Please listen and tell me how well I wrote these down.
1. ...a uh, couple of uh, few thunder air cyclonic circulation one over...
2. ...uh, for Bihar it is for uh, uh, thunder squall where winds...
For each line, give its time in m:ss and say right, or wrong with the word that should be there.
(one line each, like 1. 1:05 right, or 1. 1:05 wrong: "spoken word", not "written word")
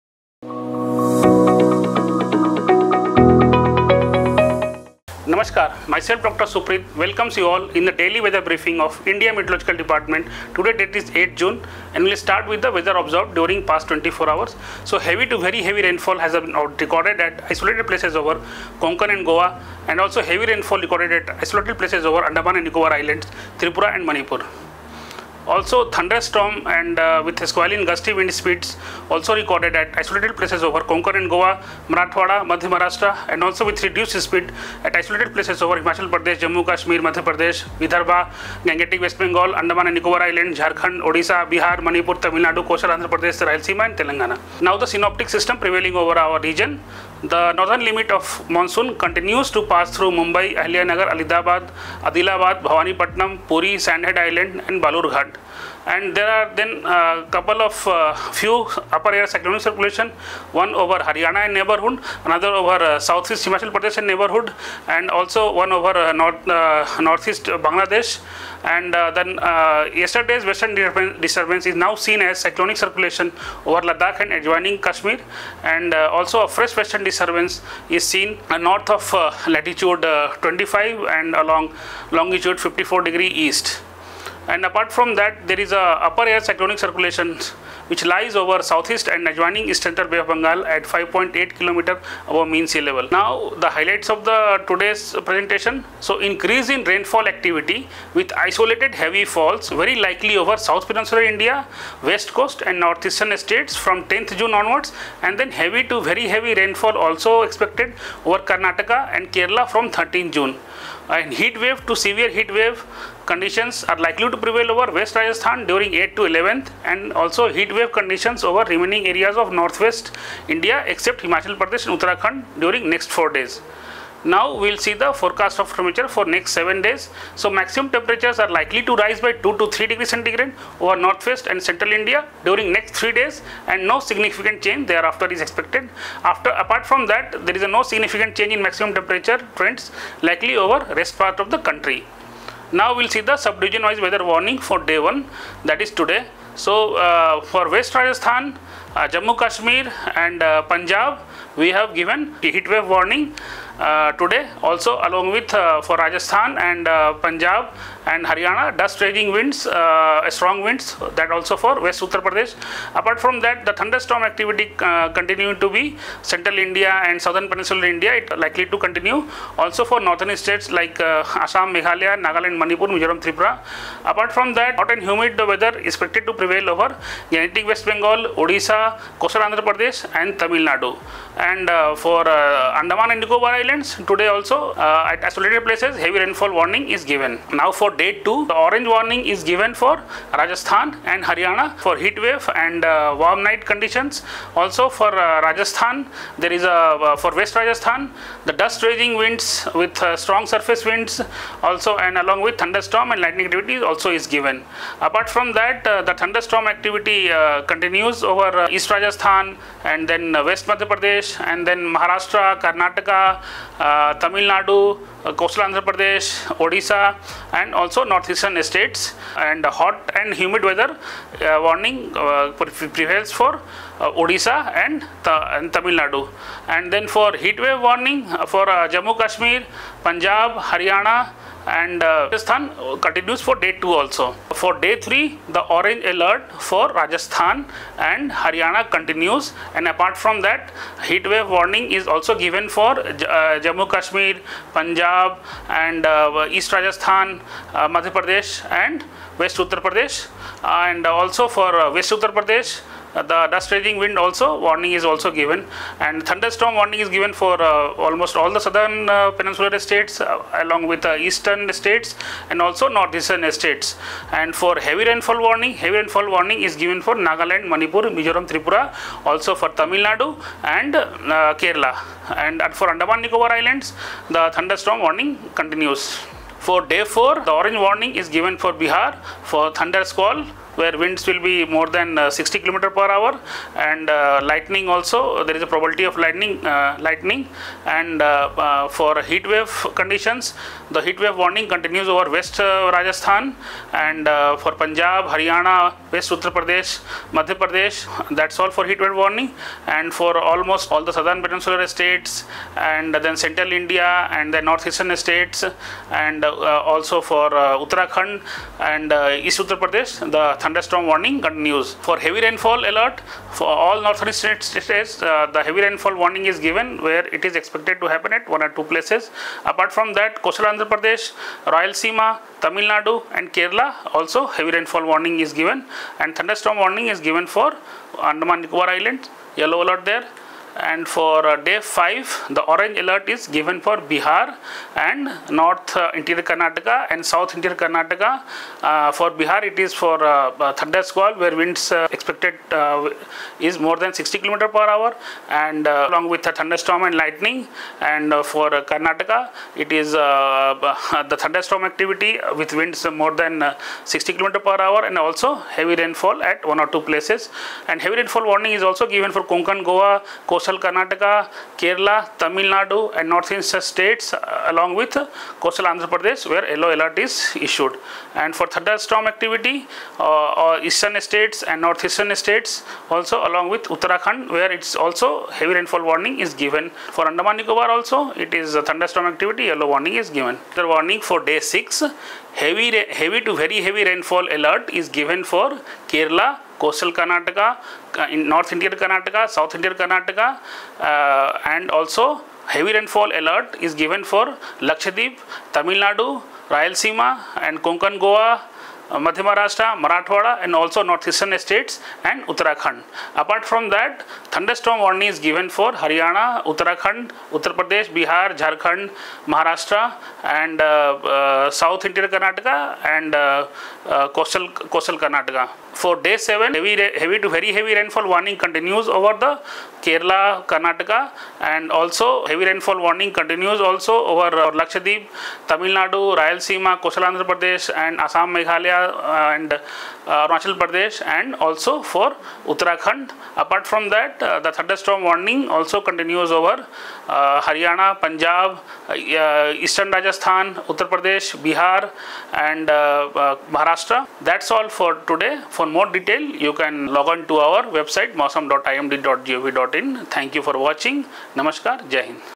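1. 0:56 wrong: "upper", not "thunder"
2. 5:38 right.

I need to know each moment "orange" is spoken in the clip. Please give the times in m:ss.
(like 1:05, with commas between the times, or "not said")
3:08, 3:55, 4:37, 5:32.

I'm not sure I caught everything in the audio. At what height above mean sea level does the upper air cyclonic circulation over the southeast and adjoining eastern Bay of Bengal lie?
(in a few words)
5.8 km.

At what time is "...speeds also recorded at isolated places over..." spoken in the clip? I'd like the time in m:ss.
0:28.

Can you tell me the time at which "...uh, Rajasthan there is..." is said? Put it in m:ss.
3:15.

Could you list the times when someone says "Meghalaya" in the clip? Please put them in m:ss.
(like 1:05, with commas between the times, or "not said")
2:51, 7:08.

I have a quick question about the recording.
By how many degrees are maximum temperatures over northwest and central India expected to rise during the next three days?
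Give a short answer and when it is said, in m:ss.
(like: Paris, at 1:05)
2 to 3 degrees, at 2:09.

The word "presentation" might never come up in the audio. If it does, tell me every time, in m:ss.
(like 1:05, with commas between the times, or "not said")
1:35.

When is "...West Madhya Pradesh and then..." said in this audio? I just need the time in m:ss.
3:30.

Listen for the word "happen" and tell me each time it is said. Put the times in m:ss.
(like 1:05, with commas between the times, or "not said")
5:18.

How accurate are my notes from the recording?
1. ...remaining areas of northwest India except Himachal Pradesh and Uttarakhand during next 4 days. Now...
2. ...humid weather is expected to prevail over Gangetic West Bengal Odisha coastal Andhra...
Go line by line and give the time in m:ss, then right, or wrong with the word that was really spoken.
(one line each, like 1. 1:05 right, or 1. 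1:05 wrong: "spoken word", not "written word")
1. 1:58 right
2. 2:55 right.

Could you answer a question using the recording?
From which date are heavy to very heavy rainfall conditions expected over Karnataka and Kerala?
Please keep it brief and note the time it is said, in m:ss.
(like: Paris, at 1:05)
13th June, at 1:49.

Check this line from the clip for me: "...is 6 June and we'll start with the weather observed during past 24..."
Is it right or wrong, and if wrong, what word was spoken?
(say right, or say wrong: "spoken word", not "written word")
wrong: "8", not "6".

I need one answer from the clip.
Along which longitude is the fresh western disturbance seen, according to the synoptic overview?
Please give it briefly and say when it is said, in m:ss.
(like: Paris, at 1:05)
54 degree east, at 1:22.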